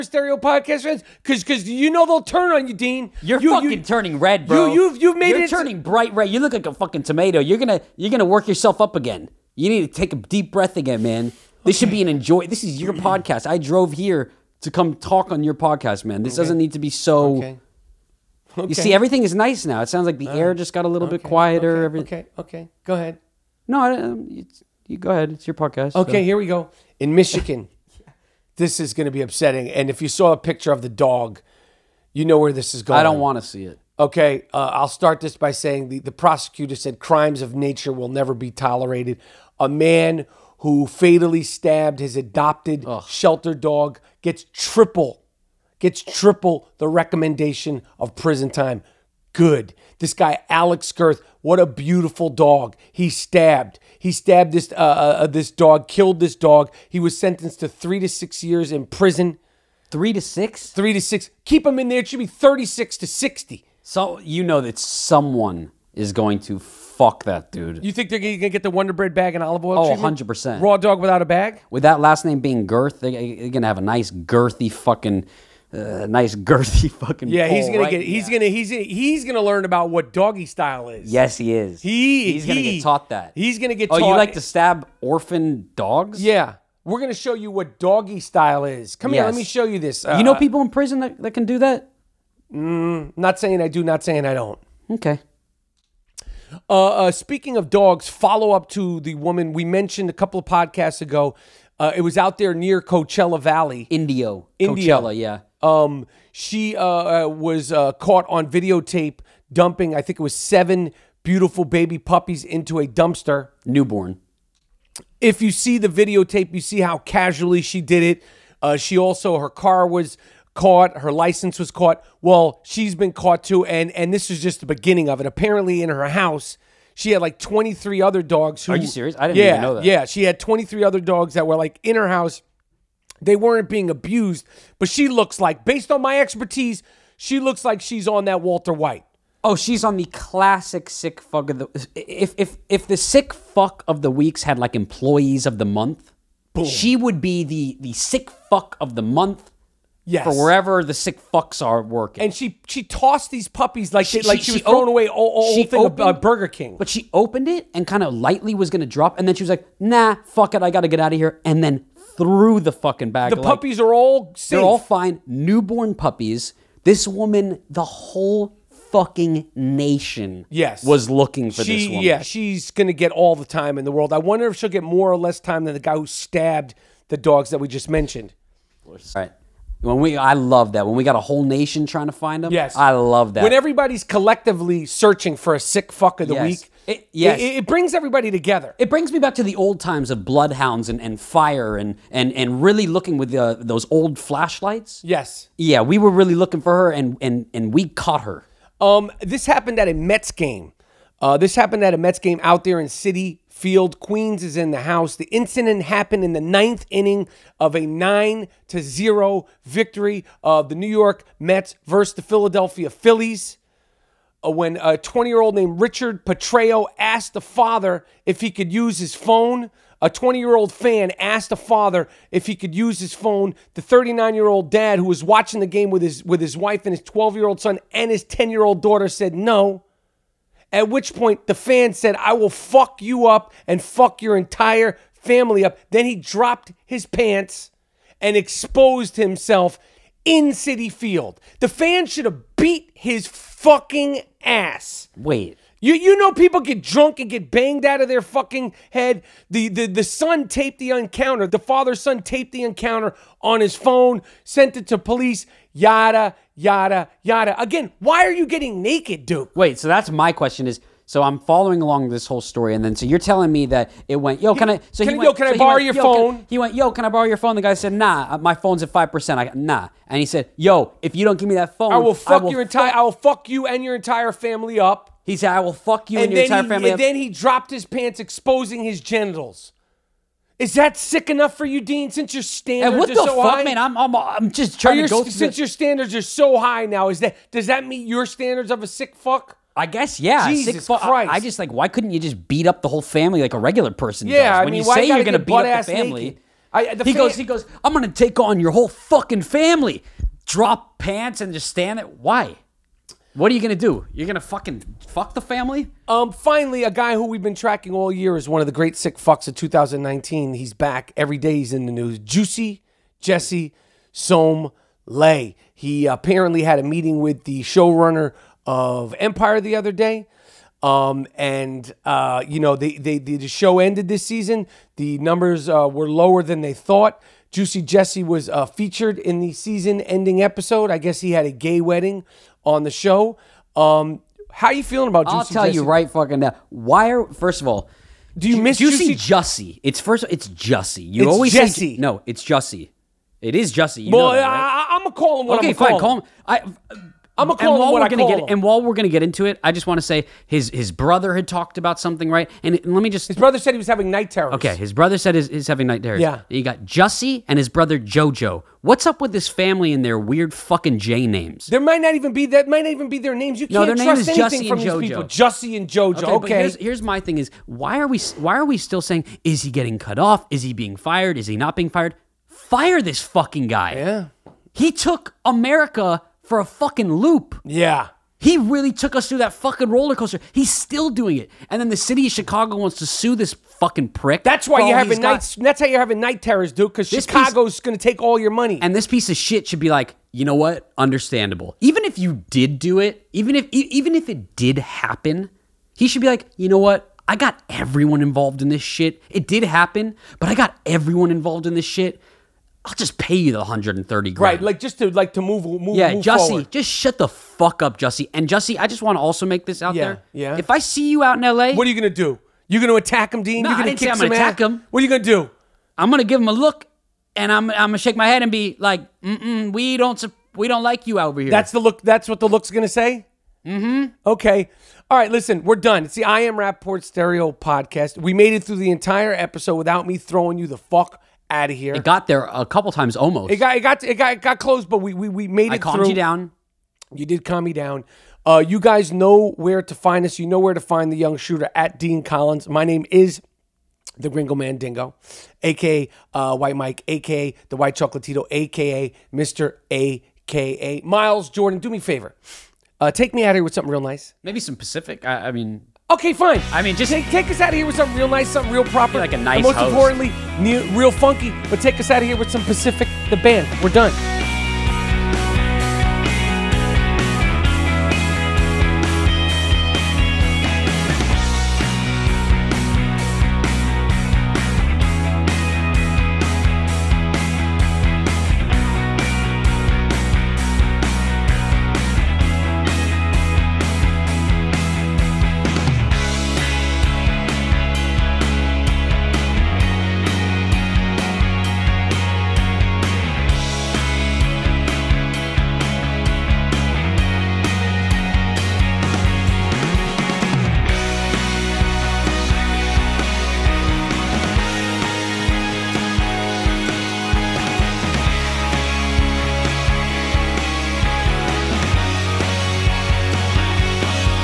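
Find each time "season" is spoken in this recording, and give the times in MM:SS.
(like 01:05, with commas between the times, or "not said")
05:24, 05:29.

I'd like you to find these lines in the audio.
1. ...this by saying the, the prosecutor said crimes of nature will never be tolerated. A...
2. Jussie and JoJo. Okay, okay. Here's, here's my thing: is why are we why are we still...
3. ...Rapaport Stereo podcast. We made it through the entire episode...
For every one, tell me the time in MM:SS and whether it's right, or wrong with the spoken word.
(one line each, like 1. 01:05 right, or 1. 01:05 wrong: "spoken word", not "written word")
1. 00:35 right
2. 06:05 right
3. 07:06 right.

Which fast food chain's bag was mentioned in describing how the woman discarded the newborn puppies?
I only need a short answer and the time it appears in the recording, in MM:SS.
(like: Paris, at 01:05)
Burger King, at 02:36.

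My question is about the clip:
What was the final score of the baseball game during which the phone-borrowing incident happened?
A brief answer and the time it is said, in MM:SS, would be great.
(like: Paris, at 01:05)
9 to 0, at 03:27.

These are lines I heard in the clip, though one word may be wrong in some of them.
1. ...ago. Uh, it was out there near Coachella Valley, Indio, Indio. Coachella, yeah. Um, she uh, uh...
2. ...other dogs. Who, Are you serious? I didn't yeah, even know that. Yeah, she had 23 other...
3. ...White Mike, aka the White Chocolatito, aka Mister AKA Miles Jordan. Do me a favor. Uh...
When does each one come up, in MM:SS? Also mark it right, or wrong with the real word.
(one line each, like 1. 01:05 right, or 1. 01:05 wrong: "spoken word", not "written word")
1. 01:41 right
2. 02:08 right
3. 07:26 right.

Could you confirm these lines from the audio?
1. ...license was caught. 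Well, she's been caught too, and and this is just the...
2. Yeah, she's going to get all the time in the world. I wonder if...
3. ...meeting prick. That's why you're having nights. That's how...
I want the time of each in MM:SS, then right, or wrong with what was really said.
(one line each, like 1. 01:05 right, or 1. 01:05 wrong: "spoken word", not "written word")
1. 02:01 right
2. 02:52 right
3. 06:23 wrong: "fucking", not "meeting".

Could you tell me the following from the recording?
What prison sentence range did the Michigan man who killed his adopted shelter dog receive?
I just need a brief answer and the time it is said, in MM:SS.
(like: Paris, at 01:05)
3 to 6 years, at 00:57.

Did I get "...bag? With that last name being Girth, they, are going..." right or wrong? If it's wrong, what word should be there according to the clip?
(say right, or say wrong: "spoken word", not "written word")
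right.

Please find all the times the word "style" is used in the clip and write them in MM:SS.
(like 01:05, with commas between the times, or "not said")
01:20, 01:28.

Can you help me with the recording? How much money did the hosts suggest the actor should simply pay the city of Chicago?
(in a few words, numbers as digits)
130 grand.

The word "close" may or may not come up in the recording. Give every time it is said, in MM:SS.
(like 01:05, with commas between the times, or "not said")
07:14.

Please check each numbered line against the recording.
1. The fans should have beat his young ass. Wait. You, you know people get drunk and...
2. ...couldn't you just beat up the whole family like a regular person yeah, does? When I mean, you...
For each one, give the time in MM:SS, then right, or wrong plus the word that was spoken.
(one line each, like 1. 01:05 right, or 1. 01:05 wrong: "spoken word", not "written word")
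1. 04:01 wrong: "fucking", not "young"
2. 04:51 right.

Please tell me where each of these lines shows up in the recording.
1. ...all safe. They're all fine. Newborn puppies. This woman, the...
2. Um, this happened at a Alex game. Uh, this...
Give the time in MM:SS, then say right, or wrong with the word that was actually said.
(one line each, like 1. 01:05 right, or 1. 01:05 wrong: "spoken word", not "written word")
1. 02:43 right
2. 03:18 wrong: "Mets", not "Alex".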